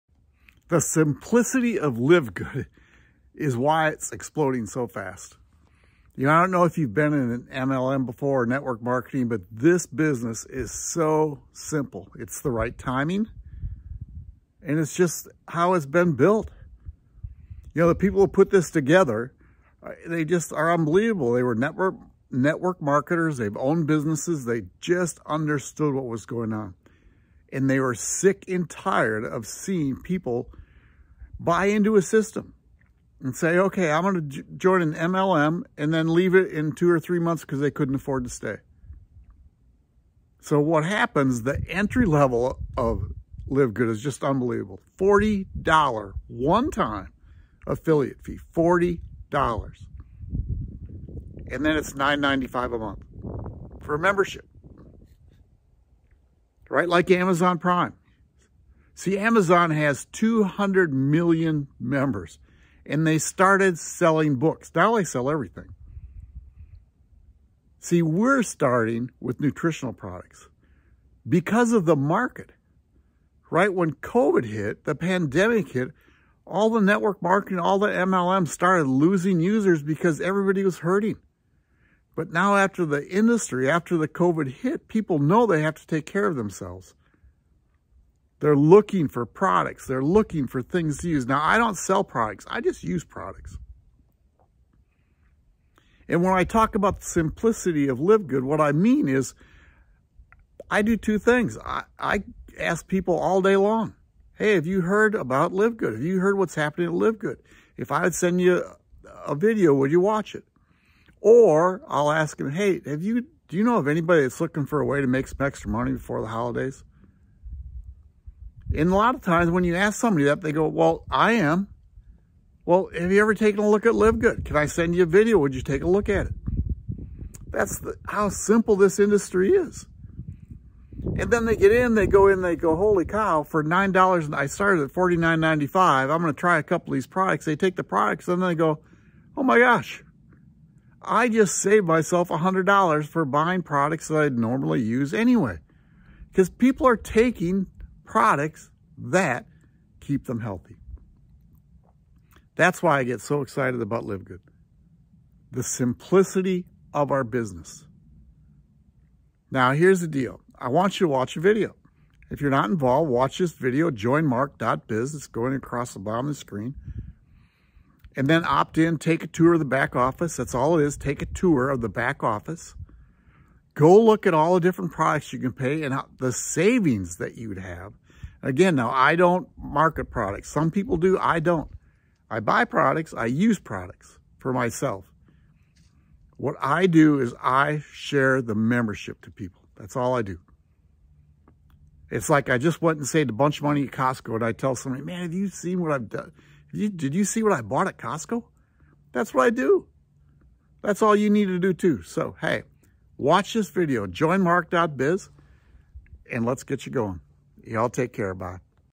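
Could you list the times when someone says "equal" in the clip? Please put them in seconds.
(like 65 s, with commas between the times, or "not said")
not said.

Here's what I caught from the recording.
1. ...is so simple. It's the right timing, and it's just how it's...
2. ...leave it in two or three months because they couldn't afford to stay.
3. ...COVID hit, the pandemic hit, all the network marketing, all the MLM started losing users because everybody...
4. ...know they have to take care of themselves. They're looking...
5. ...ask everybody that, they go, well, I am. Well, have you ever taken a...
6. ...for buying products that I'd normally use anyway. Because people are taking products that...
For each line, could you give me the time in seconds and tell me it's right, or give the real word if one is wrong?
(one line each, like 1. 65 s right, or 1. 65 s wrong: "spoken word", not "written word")
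1. 10 s right
2. 36 s right
3. 73 s right
4. 85 s right
5. 119 s wrong: "somebody", not "everybody"
6. 143 s right.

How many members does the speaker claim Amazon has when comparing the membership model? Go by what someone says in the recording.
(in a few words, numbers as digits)
200 million.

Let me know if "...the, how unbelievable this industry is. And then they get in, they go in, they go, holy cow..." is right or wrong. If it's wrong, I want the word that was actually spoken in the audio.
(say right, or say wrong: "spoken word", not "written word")
wrong: "simple", not "unbelievable".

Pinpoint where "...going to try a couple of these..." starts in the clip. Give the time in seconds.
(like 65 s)
136 s.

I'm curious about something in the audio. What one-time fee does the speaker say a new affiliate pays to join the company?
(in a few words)
$40.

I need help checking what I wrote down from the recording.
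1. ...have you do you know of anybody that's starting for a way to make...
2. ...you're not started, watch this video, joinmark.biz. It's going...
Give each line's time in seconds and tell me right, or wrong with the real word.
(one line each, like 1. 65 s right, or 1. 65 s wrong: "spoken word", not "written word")
1. 112 s wrong: "looking", not "starting"
2. 162 s wrong: "involved", not "started".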